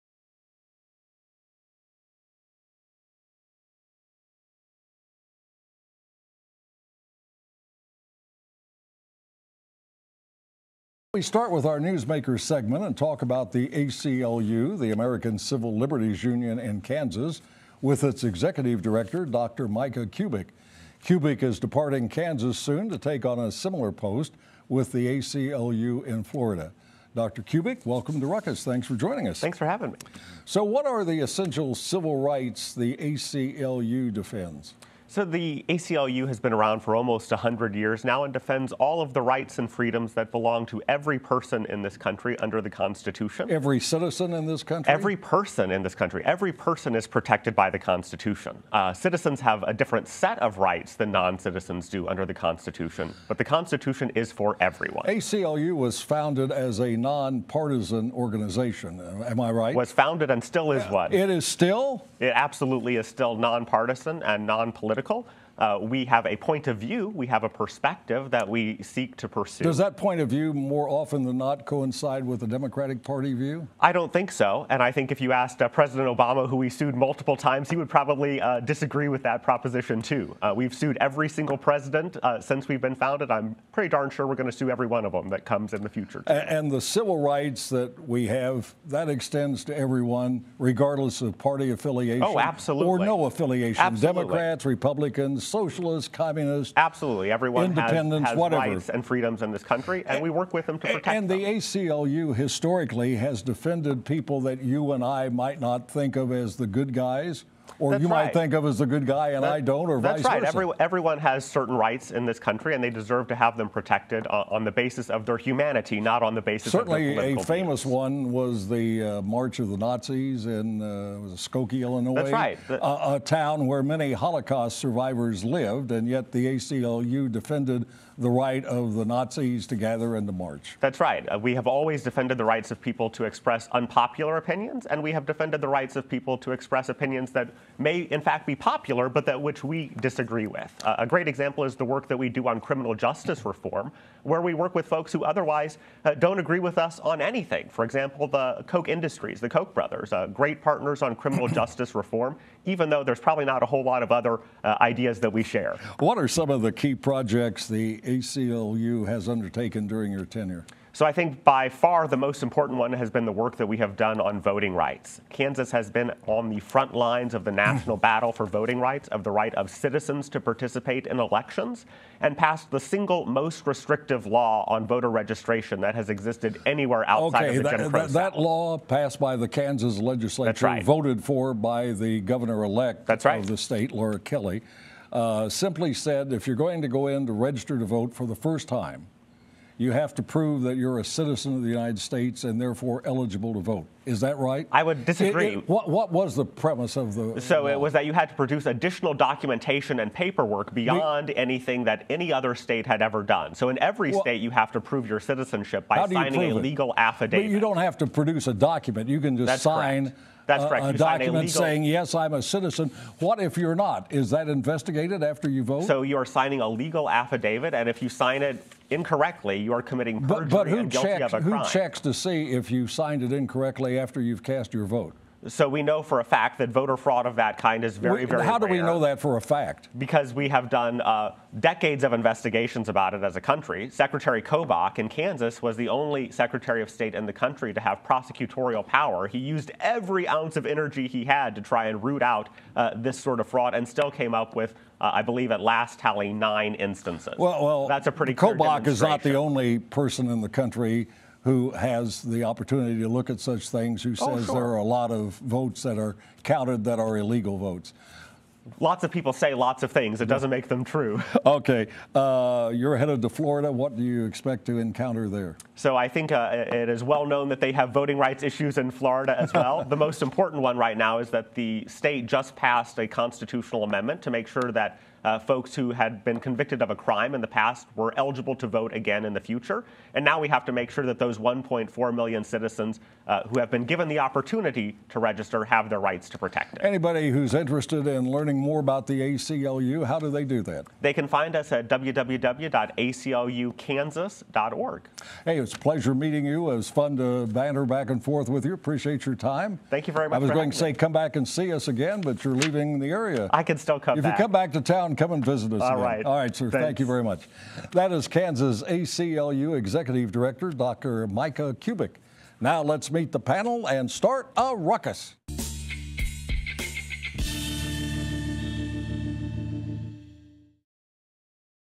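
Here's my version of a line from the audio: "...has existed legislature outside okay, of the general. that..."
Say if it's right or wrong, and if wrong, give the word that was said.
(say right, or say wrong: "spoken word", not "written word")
wrong: "anywhere", not "legislature".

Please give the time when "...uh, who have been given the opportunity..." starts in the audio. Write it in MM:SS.
04:43.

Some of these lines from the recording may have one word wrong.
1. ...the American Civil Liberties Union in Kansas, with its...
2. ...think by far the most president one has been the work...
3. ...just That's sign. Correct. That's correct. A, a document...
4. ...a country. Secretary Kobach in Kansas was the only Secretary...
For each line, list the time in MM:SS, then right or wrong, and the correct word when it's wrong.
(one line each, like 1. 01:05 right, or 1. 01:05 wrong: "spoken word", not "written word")
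1. 00:14 right
2. 02:41 wrong: "important", not "president"
3. 03:29 right
4. 03:53 right.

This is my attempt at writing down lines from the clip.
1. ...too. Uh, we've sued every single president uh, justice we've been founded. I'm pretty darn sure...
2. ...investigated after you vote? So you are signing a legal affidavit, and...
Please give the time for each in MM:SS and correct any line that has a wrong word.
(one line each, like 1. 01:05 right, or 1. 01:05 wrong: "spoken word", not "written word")
1. 01:20 wrong: "since", not "justice"
2. 03:34 right.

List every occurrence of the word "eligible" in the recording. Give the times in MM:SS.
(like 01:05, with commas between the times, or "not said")
03:13, 04:38.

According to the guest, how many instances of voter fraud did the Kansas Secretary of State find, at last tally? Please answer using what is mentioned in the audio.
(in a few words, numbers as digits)
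9.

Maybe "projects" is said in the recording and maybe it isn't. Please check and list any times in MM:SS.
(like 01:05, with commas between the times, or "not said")
02:36.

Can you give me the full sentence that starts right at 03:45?
So we know for a fact that voter fraud of that kind is very, very.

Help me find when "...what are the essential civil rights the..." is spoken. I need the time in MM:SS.
00:30.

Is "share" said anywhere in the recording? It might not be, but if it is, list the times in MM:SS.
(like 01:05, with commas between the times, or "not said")
02:35.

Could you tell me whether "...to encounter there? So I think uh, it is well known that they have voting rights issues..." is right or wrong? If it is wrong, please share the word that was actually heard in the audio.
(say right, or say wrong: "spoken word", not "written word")
right.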